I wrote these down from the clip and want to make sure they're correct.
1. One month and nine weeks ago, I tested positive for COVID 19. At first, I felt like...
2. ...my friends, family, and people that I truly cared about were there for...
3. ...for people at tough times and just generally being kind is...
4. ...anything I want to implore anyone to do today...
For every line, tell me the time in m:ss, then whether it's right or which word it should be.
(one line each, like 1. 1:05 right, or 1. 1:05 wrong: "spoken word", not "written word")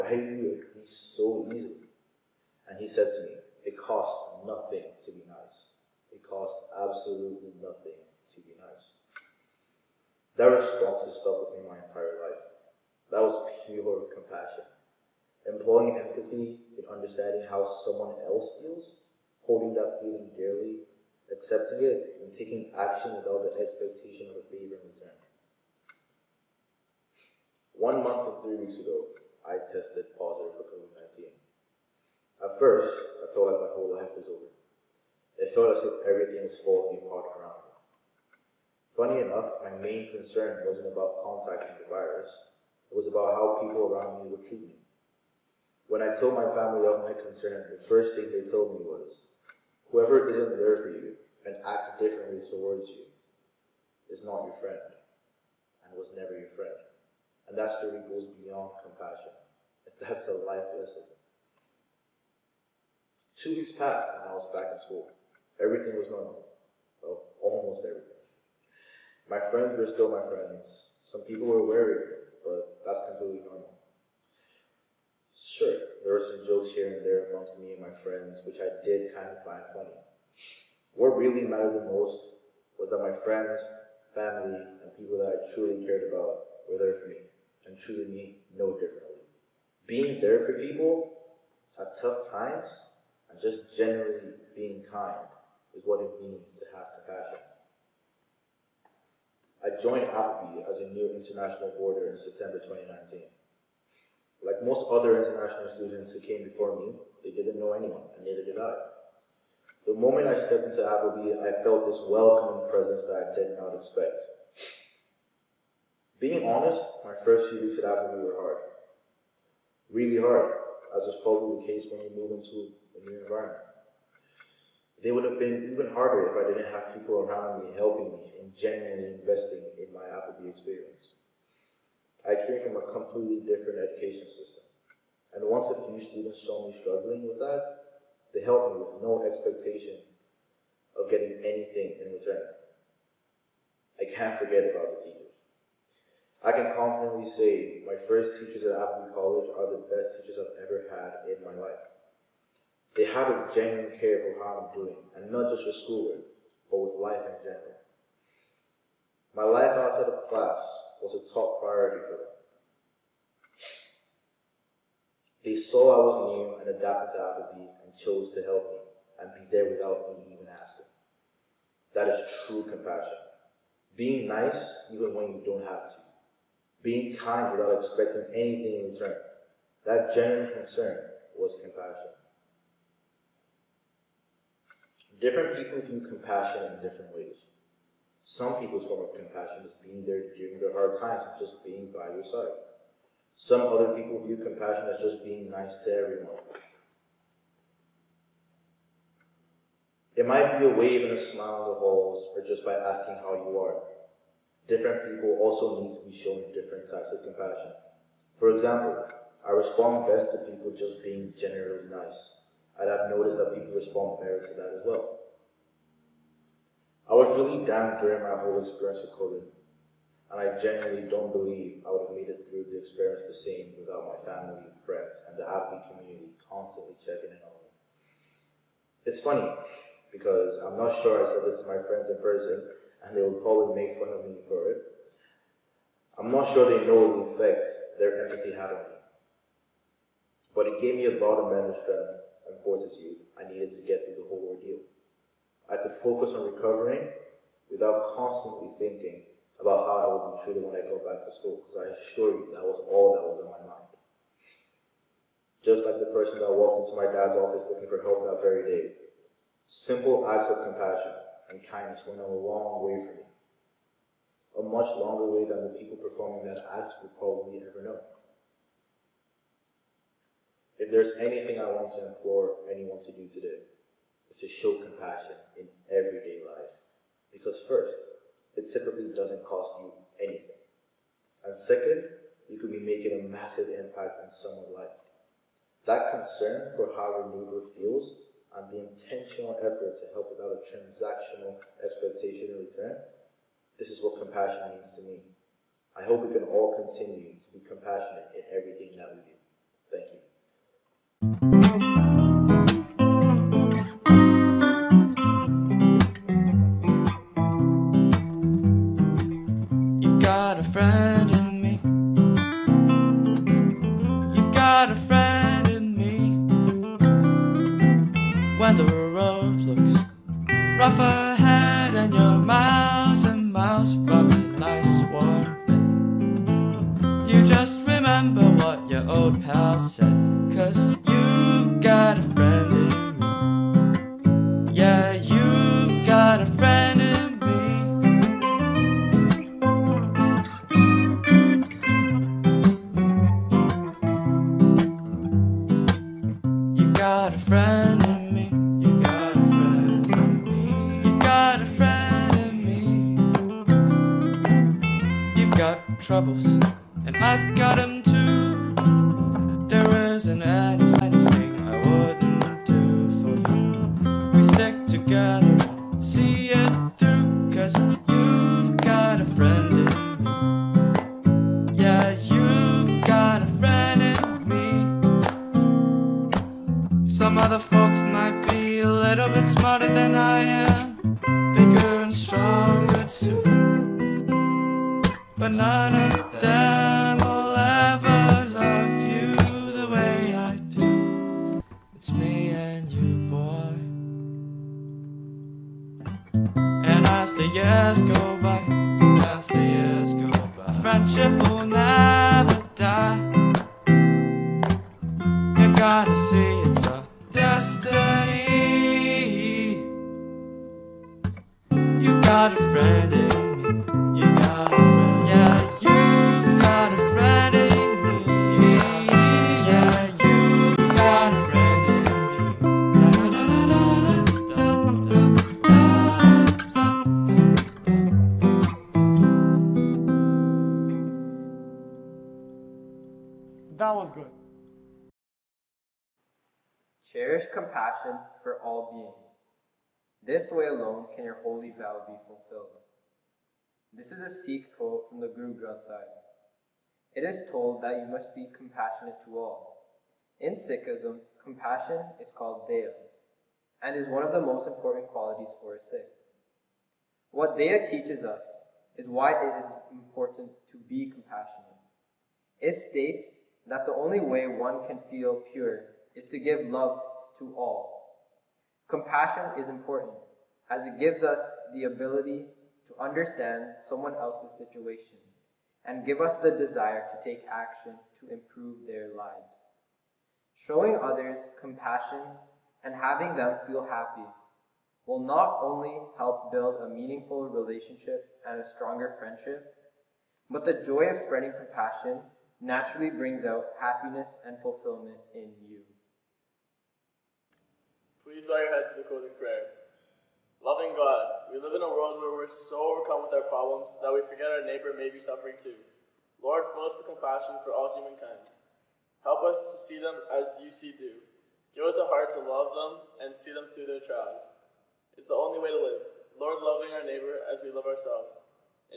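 1. 0:27 wrong: "three", not "nine"
2. 1:23 right
3. 1:30 right
4. 4:31 right.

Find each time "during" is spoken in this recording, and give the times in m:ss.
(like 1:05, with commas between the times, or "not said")
3:10, 3:37.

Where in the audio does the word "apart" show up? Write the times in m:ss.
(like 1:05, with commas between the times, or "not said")
0:37.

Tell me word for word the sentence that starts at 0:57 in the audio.
And that story goes beyond compassion.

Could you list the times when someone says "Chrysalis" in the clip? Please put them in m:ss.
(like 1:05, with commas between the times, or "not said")
not said.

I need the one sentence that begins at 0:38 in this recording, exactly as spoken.
Funny enough, my main concern wasn't about contacting the virus.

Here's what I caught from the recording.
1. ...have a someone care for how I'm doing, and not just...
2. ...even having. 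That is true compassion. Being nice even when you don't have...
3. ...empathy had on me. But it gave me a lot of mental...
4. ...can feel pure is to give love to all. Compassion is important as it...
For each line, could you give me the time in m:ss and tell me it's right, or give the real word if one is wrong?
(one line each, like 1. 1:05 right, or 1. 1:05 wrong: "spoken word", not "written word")
1. 2:33 wrong: "genuine", not "someone"
2. 2:50 wrong: "asking", not "having"
3. 3:58 right
4. 7:44 right.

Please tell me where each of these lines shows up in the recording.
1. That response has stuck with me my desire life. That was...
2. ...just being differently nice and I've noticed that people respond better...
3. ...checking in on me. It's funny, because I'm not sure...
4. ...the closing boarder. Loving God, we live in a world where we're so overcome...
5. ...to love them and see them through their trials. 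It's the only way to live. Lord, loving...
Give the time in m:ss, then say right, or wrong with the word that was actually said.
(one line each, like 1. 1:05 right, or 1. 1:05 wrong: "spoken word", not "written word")
1. 0:10 wrong: "entire", not "desire"
2. 3:30 wrong: "generally", not "differently"
3. 3:46 right
4. 8:18 wrong: "prayer", not "boarder"
5. 8:32 right.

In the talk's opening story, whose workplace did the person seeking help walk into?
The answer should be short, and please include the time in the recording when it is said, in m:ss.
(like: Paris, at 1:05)
dad's office, at 4:16.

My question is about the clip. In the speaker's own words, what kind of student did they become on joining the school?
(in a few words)
international boarder.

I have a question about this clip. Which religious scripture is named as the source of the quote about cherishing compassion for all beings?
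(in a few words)
Guru Granth Sahib.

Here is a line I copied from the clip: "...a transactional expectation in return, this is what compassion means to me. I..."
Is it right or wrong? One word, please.
right.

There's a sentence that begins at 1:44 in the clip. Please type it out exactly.
Like most other international students who came before me, they didn't know anyone, and neither did I.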